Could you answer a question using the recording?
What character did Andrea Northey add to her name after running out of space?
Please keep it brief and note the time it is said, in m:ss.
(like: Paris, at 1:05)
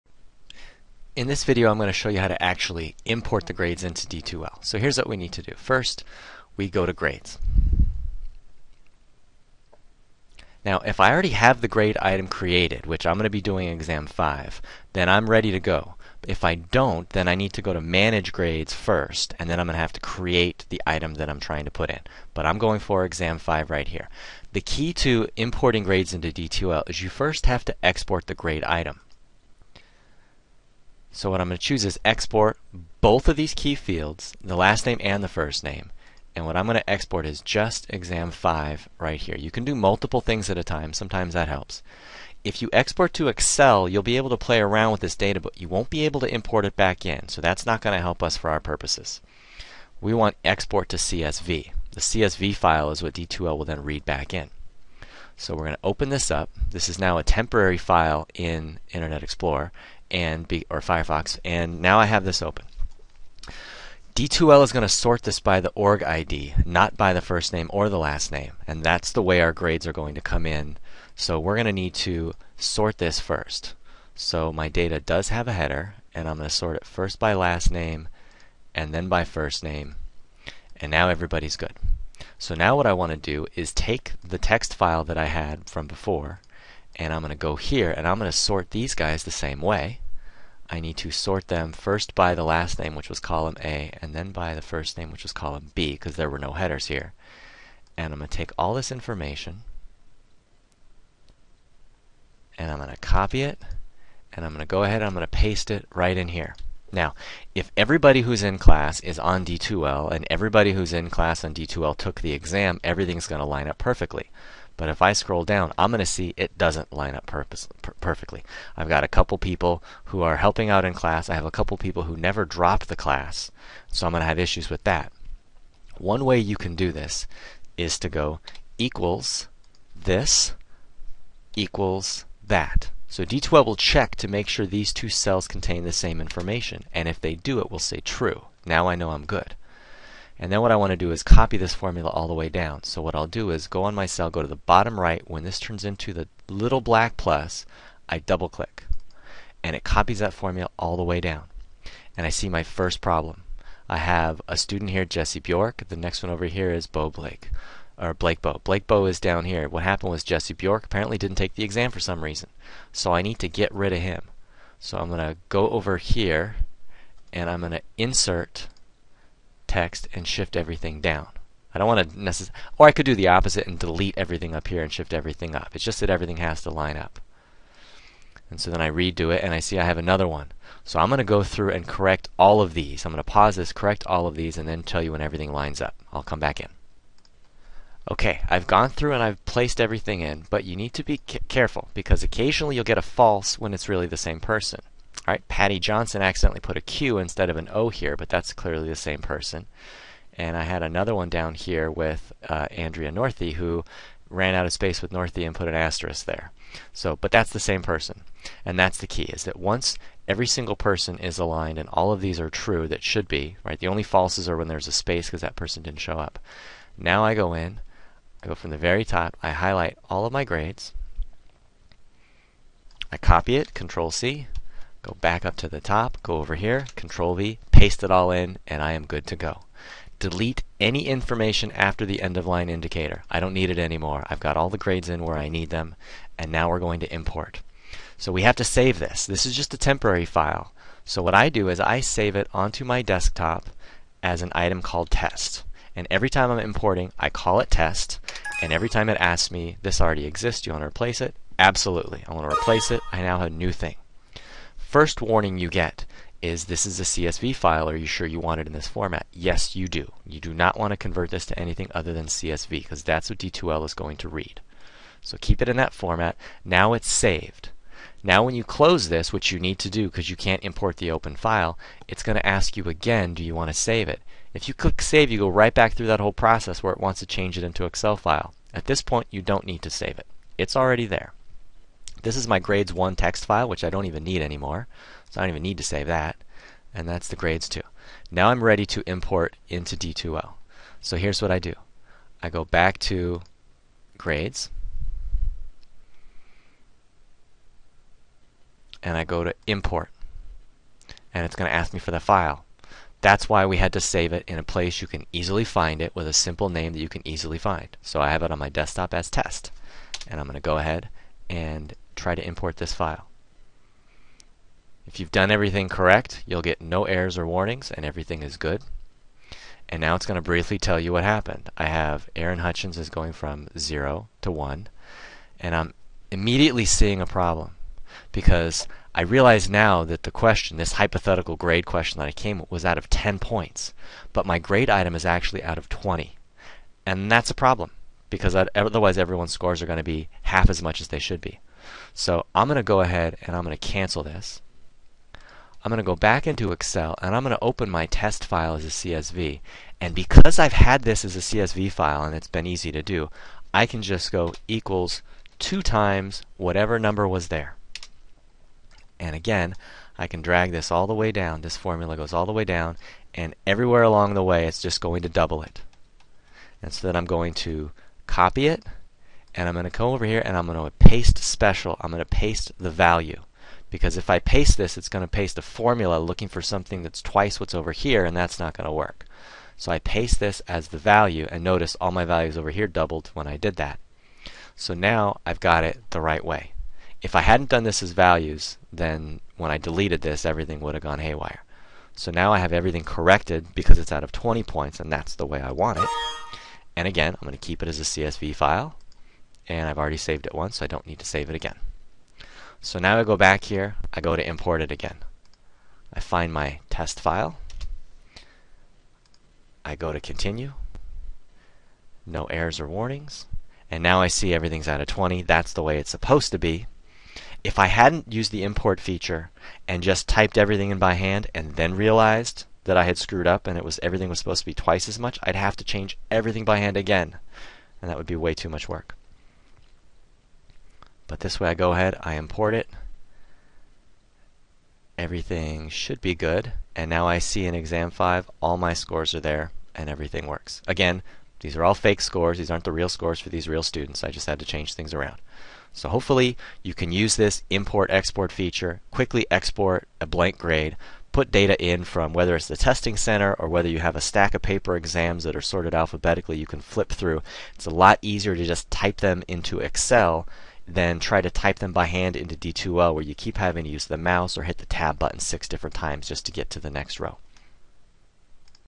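asterisk, at 3:25.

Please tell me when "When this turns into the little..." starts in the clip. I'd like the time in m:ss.
2:25.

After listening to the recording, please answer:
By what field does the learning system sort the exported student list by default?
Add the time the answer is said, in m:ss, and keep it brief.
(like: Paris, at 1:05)
org ID, at 1:05.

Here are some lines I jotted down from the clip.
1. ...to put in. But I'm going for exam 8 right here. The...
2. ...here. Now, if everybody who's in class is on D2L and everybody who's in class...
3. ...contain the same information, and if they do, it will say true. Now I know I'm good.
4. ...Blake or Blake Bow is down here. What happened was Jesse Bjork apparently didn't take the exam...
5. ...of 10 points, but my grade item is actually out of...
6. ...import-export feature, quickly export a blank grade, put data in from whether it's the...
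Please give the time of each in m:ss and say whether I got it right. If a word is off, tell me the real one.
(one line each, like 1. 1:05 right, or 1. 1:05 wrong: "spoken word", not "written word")
1. 0:21 wrong: "5", not "8"
2. 1:46 right
3. 2:15 right
4. 2:37 right
5. 5:32 right
6. 7:27 right.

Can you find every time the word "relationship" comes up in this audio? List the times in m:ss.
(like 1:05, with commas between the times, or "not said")
not said.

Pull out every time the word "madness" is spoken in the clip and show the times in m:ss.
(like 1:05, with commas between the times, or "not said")
not said.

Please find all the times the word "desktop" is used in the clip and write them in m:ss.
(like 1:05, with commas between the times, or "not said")
4:03, 5:08.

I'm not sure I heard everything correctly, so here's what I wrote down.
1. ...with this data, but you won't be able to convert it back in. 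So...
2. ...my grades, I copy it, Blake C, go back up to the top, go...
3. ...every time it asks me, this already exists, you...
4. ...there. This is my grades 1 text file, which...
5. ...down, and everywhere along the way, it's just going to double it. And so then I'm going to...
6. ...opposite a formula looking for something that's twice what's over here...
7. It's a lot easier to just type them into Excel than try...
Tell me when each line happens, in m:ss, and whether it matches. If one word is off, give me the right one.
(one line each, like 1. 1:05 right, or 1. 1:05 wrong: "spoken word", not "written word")
1. 0:44 wrong: "import", not "convert"
2. 3:40 wrong: "Control", not "Blake"
3. 4:08 right
4. 4:41 right
5. 6:02 right
6. 6:15 wrong: "paste", not "opposite"
7. 7:37 right.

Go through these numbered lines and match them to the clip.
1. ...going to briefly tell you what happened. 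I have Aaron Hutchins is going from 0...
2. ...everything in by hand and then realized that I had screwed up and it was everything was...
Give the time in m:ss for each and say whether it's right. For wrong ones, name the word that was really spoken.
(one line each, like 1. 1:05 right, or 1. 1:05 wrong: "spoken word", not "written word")
1. 5:20 right
2. 7:00 right.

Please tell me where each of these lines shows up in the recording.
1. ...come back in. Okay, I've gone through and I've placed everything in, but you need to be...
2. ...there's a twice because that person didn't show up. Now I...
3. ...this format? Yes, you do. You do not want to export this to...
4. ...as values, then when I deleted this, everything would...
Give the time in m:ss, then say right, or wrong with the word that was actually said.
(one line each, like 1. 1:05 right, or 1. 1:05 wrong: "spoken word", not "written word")
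1. 3:06 right
2. 3:34 wrong: "space", not "twice"
3. 4:18 wrong: "convert", not "export"
4. 6:28 right.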